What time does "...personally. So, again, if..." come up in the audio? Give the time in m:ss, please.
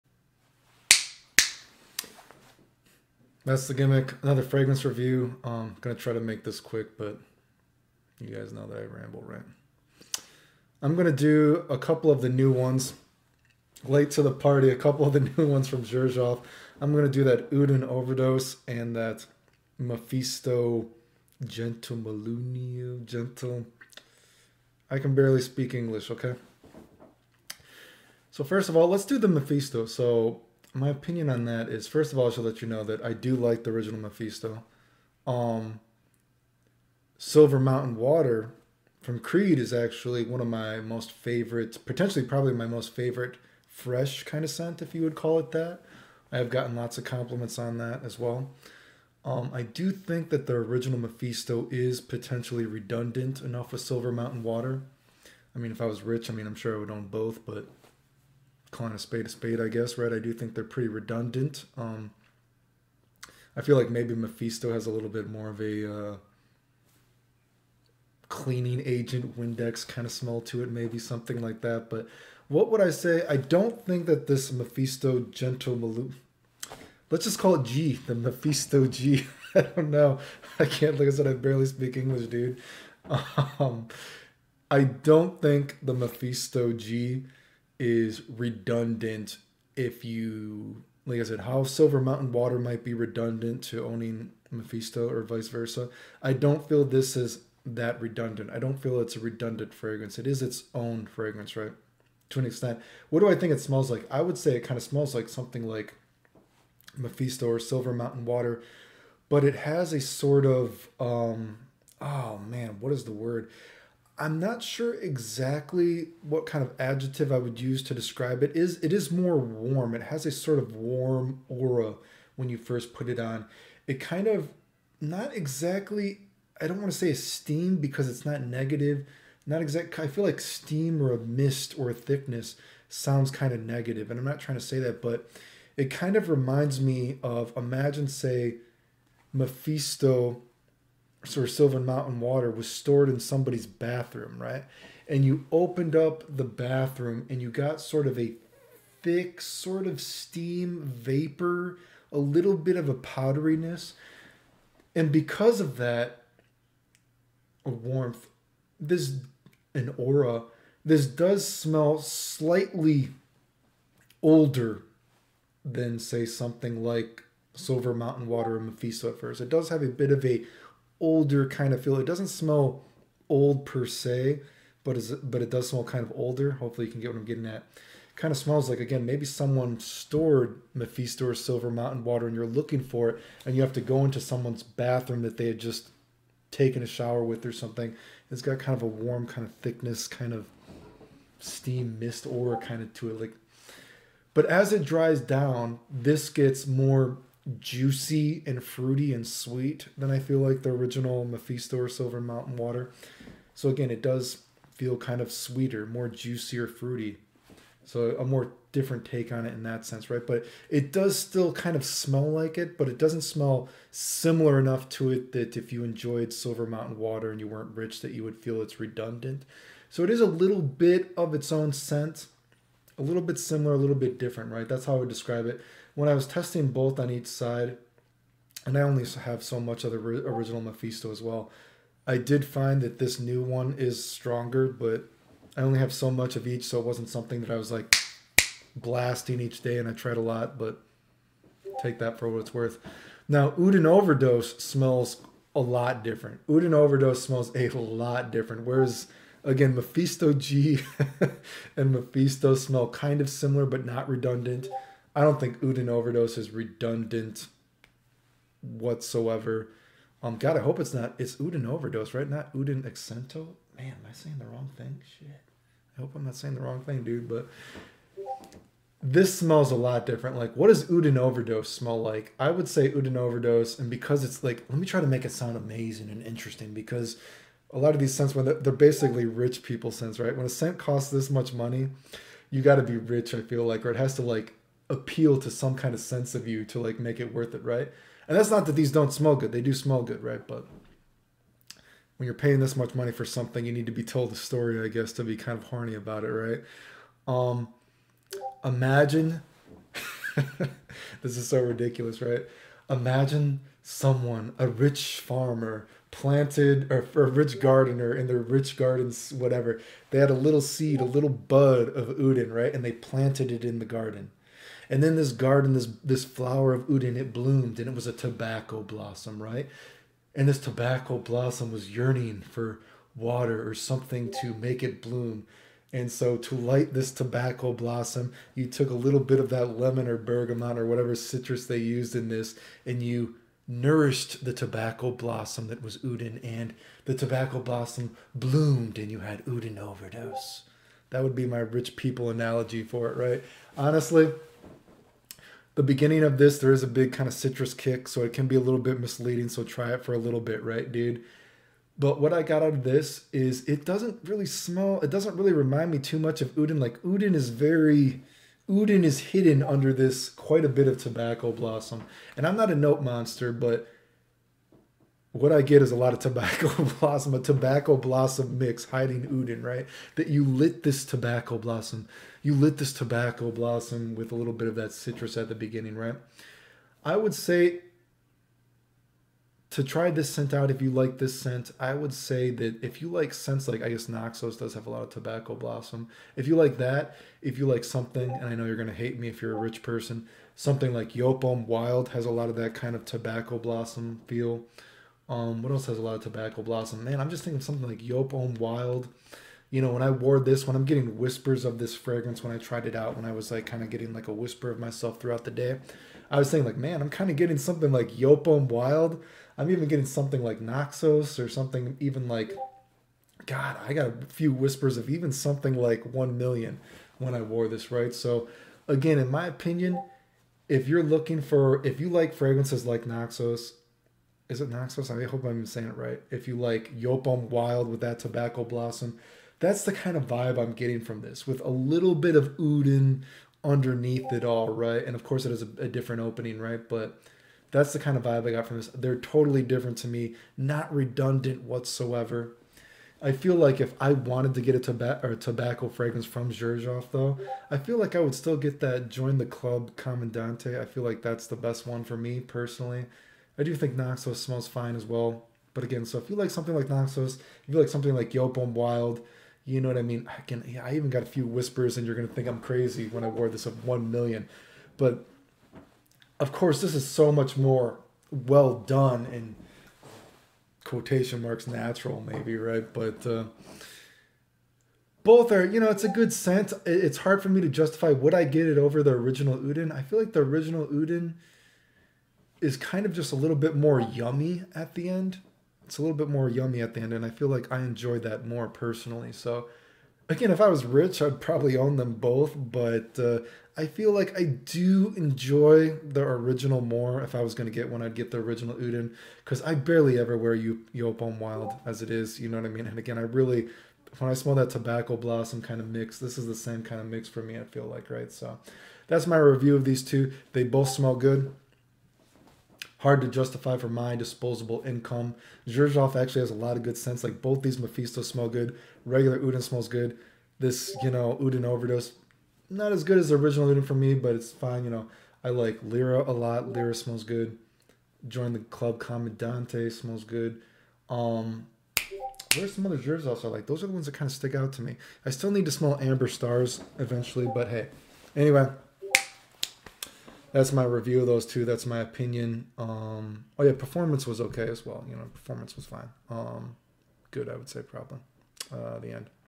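8:08.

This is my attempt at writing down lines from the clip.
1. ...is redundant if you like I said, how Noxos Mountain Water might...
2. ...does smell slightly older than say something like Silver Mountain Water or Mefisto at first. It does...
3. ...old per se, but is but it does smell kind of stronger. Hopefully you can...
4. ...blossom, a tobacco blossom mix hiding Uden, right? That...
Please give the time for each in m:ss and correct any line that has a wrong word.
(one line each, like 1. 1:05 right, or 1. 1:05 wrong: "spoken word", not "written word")
1. 1:27 wrong: "Silver", not "Noxos"
2. 2:41 right
3. 2:53 wrong: "older", not "stronger"
4. 6:06 right.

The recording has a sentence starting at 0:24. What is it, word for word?
I can barely speak English, okay?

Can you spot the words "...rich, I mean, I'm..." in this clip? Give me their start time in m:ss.
0:56.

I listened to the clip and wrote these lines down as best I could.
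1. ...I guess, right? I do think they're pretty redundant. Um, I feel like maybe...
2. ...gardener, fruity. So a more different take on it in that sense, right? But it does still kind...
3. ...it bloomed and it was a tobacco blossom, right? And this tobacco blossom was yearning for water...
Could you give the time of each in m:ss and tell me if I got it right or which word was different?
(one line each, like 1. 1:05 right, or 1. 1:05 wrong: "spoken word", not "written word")
1. 0:59 right
2. 3:26 wrong: "juicier", not "gardener"
3. 5:17 right.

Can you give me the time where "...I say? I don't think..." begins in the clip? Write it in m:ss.
1:12.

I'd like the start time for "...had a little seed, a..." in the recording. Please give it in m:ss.
5:10.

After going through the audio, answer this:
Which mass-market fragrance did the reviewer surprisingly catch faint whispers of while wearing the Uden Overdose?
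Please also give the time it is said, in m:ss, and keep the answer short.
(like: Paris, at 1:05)
1 Million, at 6:56.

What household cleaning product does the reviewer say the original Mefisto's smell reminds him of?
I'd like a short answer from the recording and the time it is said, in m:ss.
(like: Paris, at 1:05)
Windex, at 1:09.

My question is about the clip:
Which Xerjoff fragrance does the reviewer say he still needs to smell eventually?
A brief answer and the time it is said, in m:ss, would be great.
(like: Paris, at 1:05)
Amber Stars, at 8:55.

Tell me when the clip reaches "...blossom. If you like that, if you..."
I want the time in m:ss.
6:25.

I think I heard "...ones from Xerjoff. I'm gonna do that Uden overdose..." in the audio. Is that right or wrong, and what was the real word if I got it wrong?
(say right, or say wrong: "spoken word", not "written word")
right.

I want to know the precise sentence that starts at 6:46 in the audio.
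I was saying like, man, I'm kind of getting something like Yopom Wild.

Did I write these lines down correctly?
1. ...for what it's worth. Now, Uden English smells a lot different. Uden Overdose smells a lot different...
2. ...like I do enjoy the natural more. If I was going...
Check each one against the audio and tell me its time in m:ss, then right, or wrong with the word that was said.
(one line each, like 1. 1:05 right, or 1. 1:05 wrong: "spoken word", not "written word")
1. 4:02 wrong: "Overdose", not "English"
2. 8:14 wrong: "original", not "natural".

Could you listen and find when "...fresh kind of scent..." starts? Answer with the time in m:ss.
0:43.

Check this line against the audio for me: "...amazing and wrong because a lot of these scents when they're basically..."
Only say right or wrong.
wrong.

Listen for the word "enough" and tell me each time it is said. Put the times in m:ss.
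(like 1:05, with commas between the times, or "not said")
0:53, 3:34.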